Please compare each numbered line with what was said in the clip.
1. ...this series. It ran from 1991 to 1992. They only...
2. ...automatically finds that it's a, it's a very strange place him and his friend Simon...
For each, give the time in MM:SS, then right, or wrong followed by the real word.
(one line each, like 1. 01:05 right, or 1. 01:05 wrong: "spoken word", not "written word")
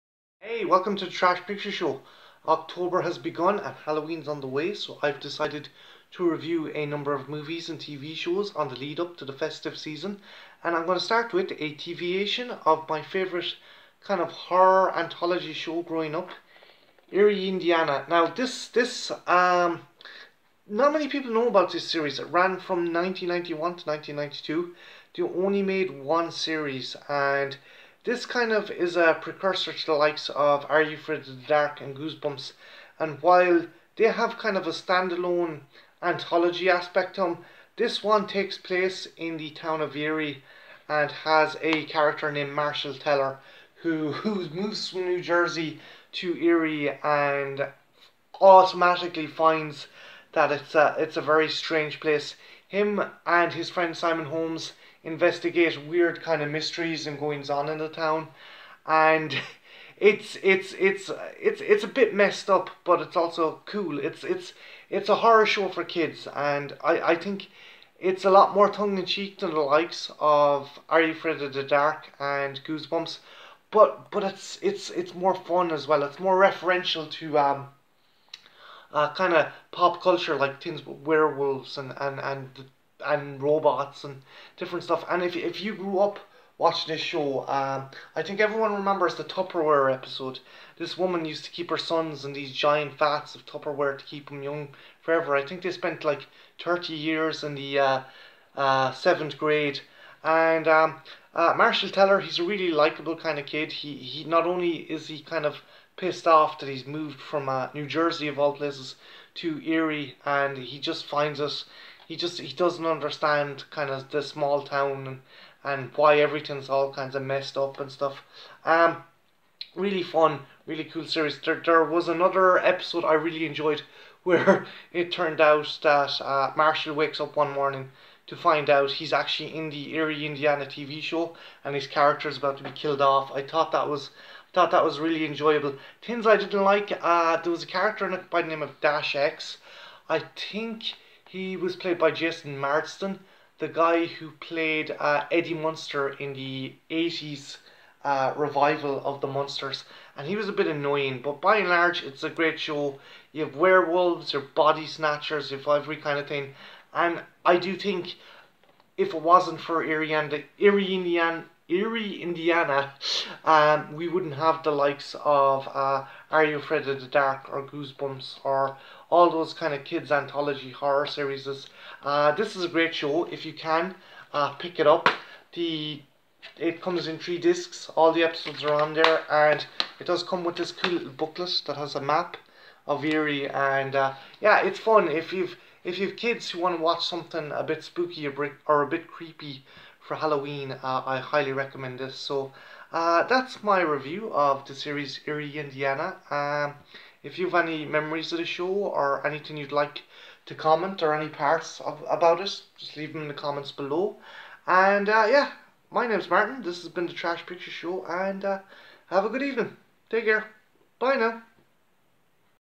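1. 00:21 right
2. 00:48 right.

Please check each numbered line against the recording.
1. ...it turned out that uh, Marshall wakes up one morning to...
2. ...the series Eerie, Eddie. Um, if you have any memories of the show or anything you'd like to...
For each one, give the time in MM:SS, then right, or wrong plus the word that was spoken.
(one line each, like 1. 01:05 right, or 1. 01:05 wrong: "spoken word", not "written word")
1. 02:04 right
2. 03:14 wrong: "Indiana", not "Eddie".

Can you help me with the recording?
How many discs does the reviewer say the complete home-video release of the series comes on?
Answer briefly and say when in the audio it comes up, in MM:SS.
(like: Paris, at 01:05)
3, at 02:57.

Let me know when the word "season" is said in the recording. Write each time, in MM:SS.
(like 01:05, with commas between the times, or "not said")
00:09.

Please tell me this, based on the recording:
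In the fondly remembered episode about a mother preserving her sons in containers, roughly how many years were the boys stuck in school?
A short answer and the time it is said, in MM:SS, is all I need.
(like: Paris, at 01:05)
30, at 01:36.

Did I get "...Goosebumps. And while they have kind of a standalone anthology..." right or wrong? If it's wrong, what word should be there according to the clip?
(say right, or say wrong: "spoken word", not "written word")
right.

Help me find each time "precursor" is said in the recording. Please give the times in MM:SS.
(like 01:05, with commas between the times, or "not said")
00:29.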